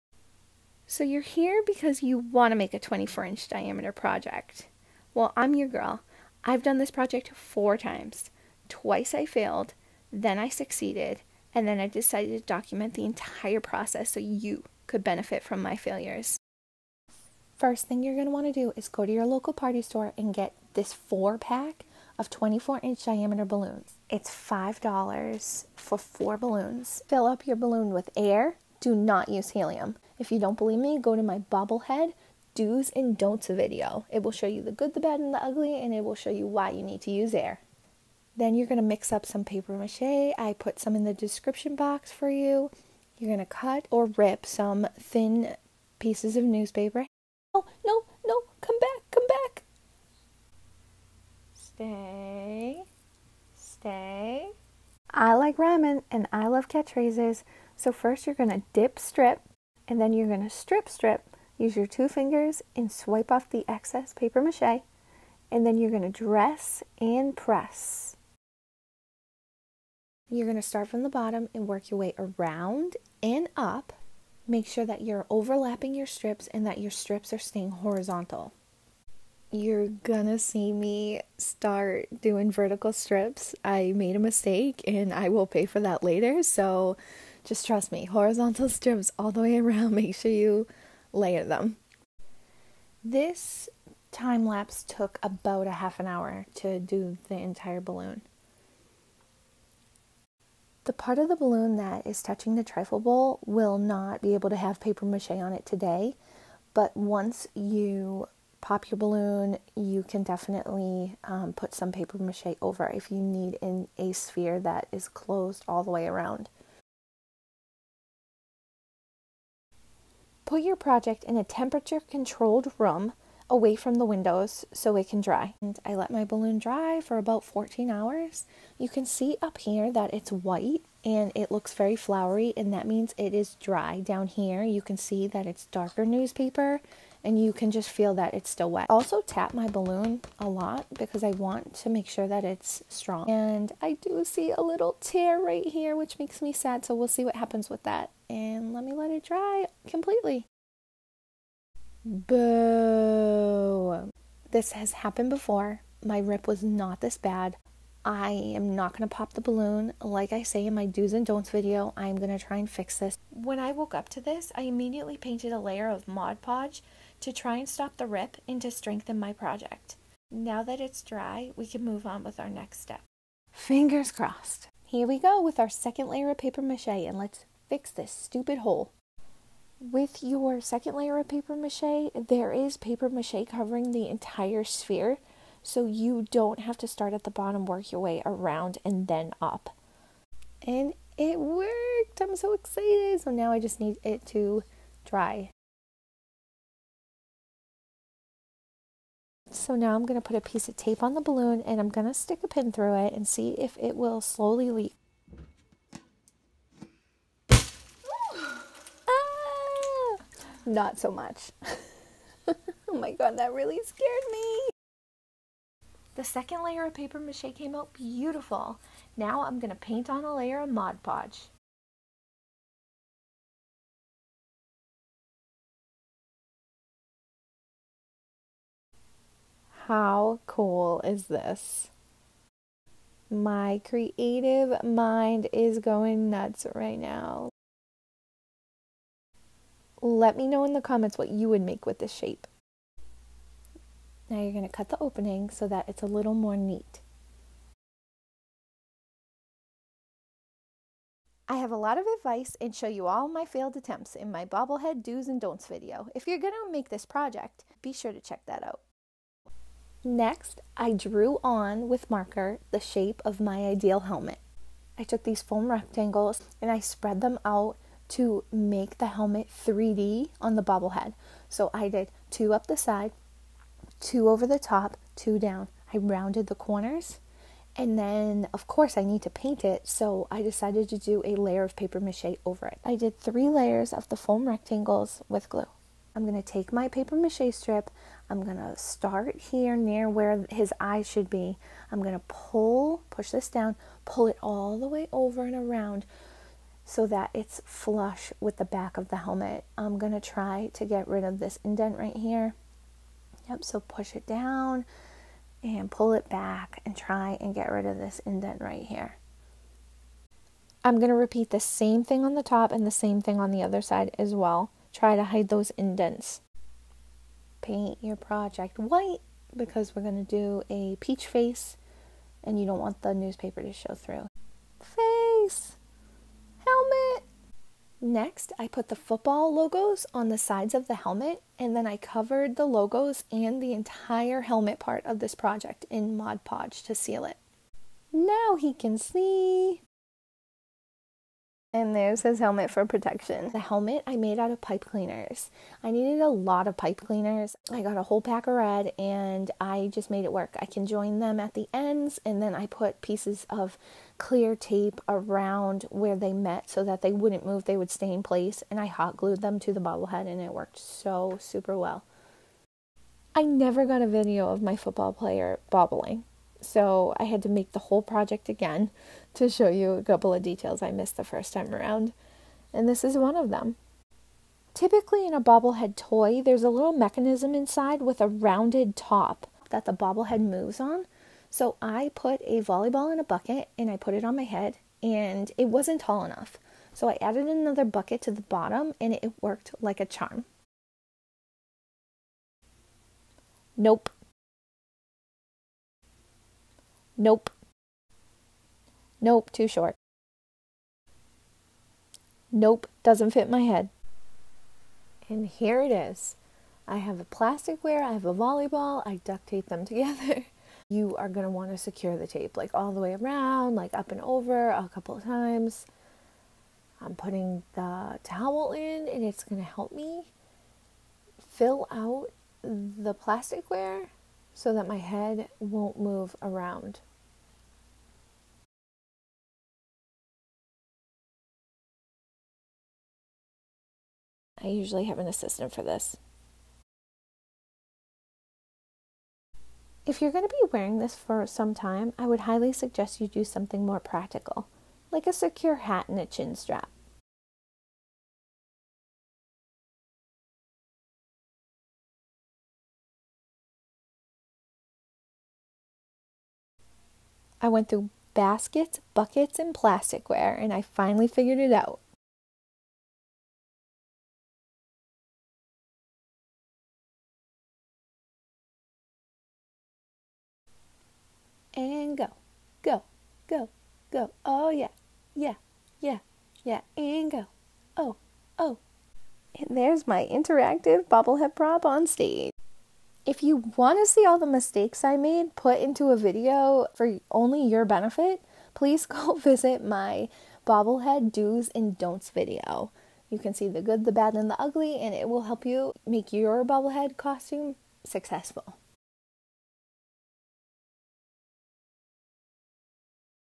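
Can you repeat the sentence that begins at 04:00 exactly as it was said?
Let me know in the comments what you would make with this shape.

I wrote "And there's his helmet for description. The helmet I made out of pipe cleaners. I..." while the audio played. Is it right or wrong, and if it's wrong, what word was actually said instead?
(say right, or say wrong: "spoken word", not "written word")
wrong: "protection", not "description".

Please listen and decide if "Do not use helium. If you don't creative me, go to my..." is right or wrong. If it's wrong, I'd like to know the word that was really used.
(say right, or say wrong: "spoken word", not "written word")
wrong: "believe", not "creative".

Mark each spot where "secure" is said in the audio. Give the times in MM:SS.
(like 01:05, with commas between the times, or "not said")
06:51, 07:25.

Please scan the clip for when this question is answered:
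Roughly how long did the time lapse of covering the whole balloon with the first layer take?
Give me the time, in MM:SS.
01:35.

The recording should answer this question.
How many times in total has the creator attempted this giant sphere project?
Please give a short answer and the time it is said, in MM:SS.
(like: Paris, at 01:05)
4, at 00:07.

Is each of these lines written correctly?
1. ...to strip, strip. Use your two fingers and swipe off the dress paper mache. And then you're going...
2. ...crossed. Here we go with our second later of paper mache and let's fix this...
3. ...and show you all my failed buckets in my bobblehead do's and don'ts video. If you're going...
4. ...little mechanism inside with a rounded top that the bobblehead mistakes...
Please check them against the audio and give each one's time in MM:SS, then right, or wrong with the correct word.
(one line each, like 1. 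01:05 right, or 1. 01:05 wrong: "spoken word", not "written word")
1. 01:00 wrong: "excess", not "dress"
2. 02:54 wrong: "layer", not "later"
3. 04:12 wrong: "attempts", not "buckets"
4. 06:16 wrong: "moves", not "mistakes".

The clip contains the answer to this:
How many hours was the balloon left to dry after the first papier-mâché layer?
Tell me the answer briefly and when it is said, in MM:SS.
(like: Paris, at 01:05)
14, at 02:07.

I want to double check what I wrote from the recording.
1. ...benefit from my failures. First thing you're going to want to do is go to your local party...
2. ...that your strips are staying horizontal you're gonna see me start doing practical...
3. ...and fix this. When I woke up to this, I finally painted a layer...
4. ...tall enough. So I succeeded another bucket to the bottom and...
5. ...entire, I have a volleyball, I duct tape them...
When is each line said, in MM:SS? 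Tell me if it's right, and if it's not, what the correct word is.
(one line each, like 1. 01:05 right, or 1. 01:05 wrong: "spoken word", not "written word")
1. 00:15 right
2. 01:16 wrong: "vertical", not "practical"
3. 02:42 wrong: "immediately", not "finally"
4. 06:25 wrong: "added", not "succeeded"
5. 06:47 wrong: "plasticware", not "entire".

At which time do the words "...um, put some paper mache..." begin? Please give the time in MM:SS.
01:51.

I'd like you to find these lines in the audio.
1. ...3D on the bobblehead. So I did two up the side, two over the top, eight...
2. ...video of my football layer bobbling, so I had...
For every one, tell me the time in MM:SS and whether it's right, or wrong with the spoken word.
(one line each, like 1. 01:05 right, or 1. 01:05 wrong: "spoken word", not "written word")
1. 04:29 wrong: "two", not "eight"
2. 06:04 wrong: "player", not "layer".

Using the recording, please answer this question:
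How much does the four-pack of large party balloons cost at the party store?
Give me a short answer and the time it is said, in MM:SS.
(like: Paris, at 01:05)
$5, at 00:24.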